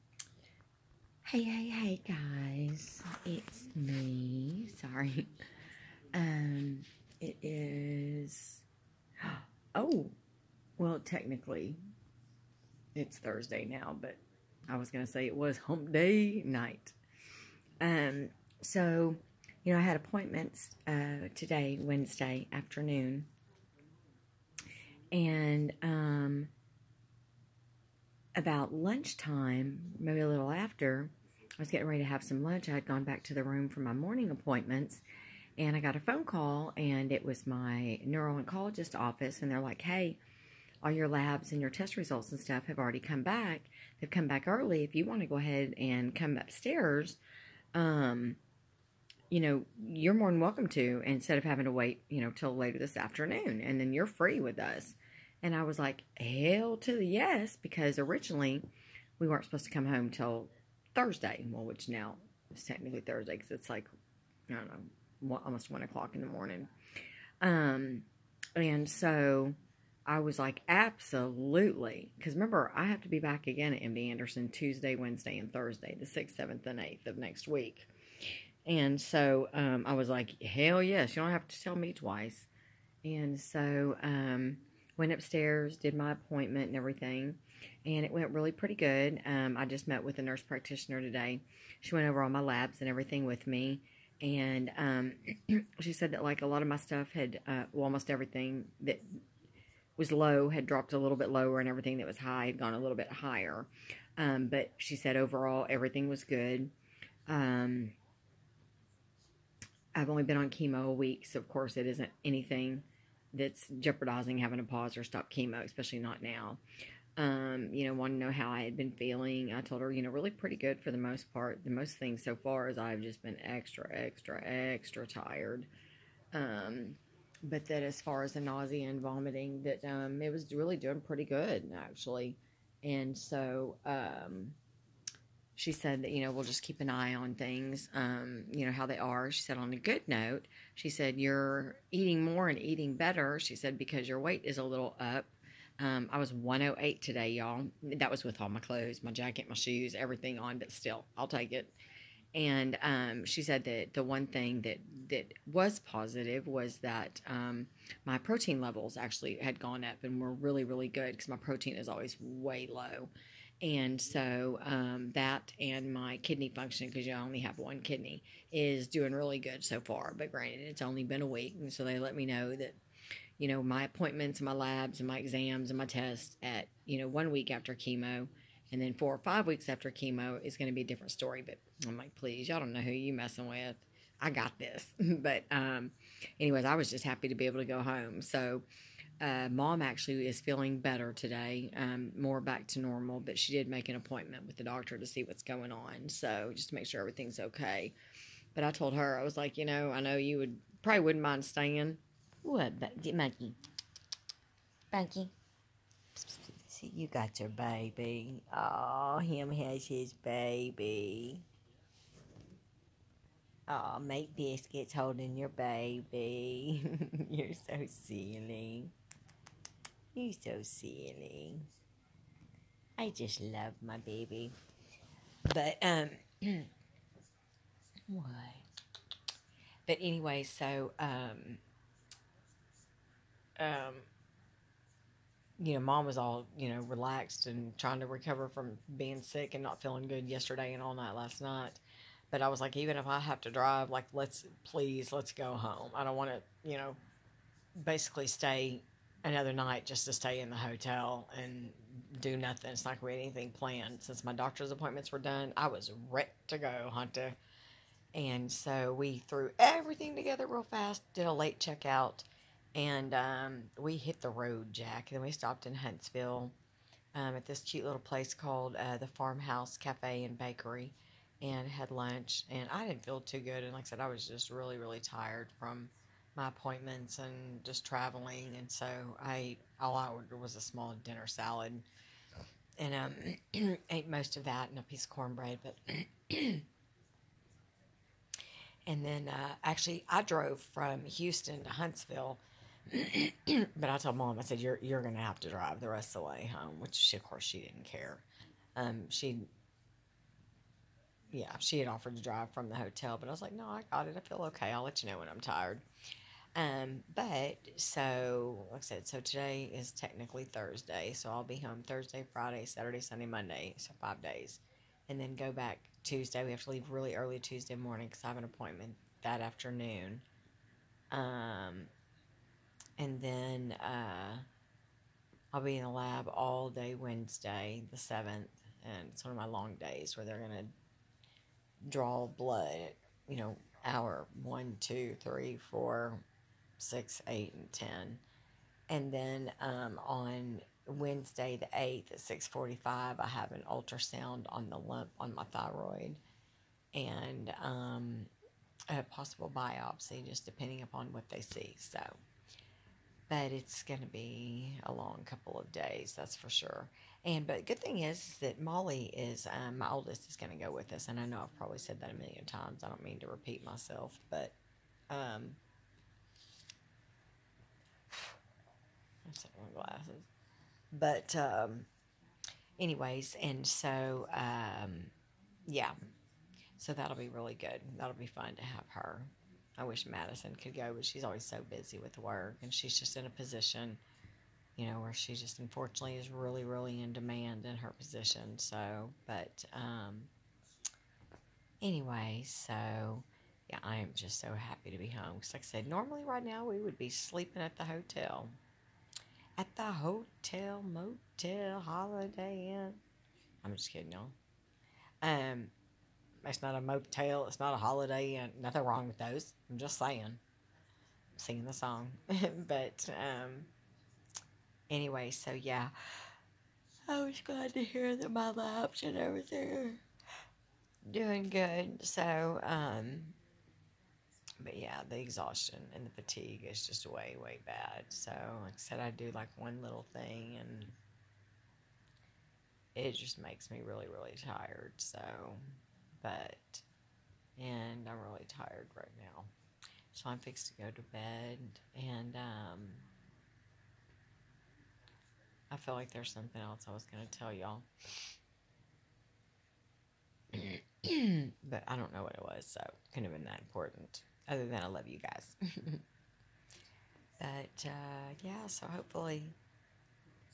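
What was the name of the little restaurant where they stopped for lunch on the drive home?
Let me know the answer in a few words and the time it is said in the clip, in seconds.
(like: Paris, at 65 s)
Farmhouse Cafe and Bakery, at 269 s.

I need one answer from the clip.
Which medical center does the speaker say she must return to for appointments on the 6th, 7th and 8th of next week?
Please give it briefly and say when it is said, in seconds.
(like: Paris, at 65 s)
MD Anderson, at 73 s.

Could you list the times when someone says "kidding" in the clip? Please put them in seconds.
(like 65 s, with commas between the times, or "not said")
403 s.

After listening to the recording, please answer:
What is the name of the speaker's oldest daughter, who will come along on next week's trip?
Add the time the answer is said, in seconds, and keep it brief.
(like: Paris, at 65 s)
Molly, at 358 s.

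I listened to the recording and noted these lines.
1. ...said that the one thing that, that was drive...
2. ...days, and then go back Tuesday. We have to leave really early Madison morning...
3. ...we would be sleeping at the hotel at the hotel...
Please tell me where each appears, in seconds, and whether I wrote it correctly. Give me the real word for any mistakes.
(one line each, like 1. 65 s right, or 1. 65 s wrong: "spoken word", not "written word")
1. 153 s wrong: "positive", not "drive"
2. 314 s wrong: "Tuesday", not "Madison"
3. 396 s right.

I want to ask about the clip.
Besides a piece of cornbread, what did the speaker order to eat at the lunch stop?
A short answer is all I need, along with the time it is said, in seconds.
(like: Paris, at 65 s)
small dinner salad, at 280 s.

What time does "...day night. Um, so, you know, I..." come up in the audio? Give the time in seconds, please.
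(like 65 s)
15 s.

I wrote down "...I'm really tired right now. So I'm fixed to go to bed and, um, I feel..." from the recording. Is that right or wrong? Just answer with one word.
right.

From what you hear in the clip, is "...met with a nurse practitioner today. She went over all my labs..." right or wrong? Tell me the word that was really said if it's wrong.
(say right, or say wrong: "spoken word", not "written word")
right.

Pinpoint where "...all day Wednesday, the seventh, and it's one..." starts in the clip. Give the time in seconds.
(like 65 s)
326 s.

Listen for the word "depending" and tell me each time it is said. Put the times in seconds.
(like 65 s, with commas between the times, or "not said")
350 s.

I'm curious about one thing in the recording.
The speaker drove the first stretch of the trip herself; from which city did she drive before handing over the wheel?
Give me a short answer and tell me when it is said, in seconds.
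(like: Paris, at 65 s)
Houston, at 291 s.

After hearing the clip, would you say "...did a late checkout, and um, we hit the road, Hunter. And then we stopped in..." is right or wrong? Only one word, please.
wrong.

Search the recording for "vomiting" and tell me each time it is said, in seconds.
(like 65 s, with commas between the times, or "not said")
129 s.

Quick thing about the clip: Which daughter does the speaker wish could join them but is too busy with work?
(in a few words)
Madison.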